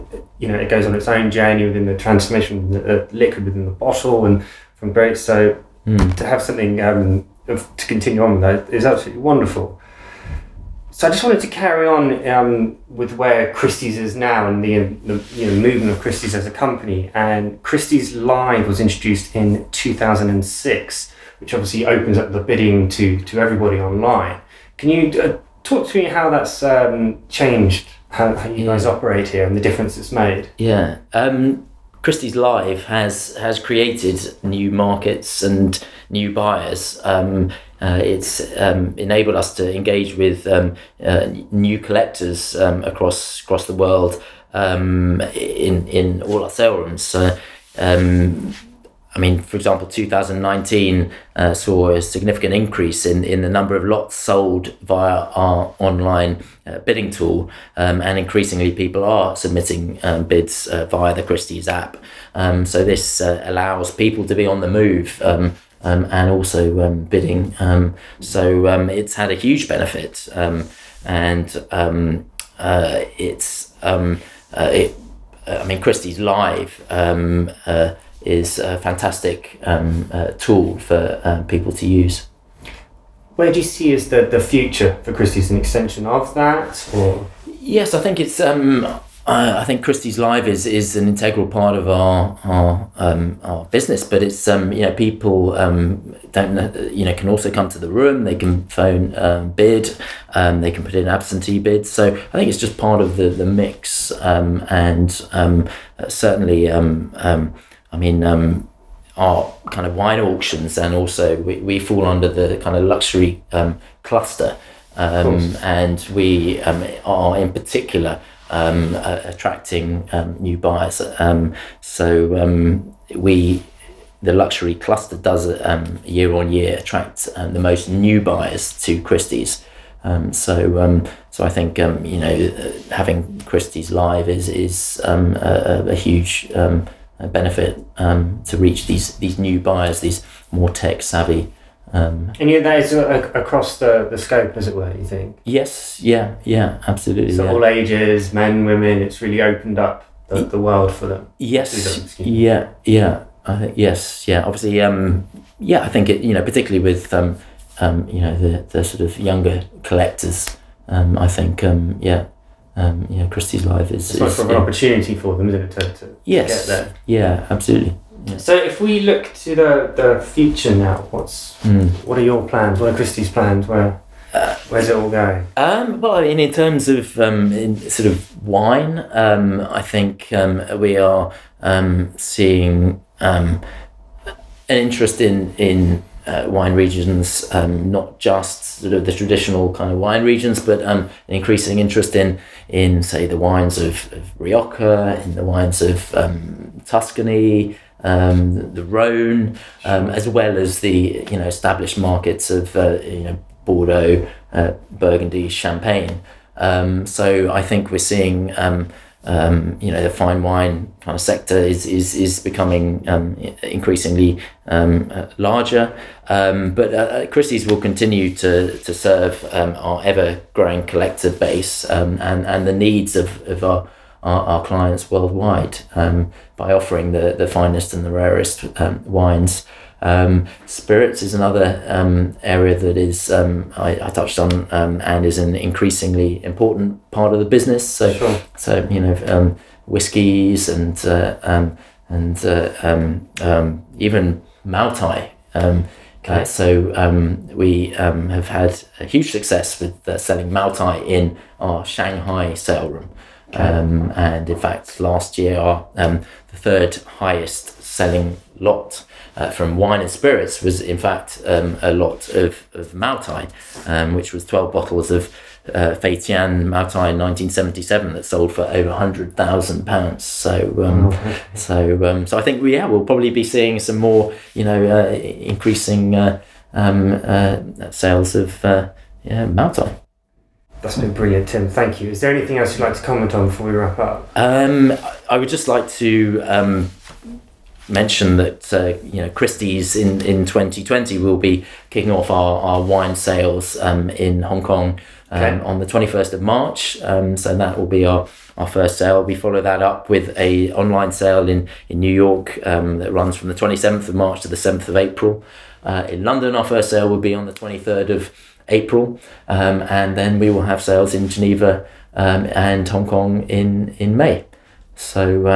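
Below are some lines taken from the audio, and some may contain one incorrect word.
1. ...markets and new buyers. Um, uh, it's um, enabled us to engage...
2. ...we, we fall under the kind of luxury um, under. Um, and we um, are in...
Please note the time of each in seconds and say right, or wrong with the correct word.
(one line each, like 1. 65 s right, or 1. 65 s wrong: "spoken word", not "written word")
1. 34 s right
2. 111 s wrong: "cluster", not "under".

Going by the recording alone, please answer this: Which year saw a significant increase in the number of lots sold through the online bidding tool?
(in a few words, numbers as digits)
2019.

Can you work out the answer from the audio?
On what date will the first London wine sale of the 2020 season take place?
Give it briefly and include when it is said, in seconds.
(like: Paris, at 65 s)
23rd of April, at 307 s.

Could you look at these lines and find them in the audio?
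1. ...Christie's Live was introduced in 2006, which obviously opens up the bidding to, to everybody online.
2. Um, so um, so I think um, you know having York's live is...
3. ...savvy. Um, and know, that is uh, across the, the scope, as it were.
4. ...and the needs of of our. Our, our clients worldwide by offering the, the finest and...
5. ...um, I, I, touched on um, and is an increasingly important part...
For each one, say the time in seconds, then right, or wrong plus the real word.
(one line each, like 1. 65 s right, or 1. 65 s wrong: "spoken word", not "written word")
1. 17 s right
2. 130 s wrong: "Christie", not "York"
3. 141 s right
4. 222 s right
5. 233 s right.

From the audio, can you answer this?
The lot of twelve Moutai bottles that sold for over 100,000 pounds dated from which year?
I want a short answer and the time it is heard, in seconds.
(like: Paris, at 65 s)
1977, at 266 s.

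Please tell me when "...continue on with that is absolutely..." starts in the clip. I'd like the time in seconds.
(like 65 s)
7 s.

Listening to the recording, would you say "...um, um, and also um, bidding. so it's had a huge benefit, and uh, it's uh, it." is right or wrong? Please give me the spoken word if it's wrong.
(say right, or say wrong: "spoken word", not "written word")
right.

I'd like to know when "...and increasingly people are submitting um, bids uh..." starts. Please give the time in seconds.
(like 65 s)
58 s.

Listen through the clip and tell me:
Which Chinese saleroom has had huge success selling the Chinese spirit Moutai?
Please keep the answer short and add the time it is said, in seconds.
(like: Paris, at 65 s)
Shanghai, at 251 s.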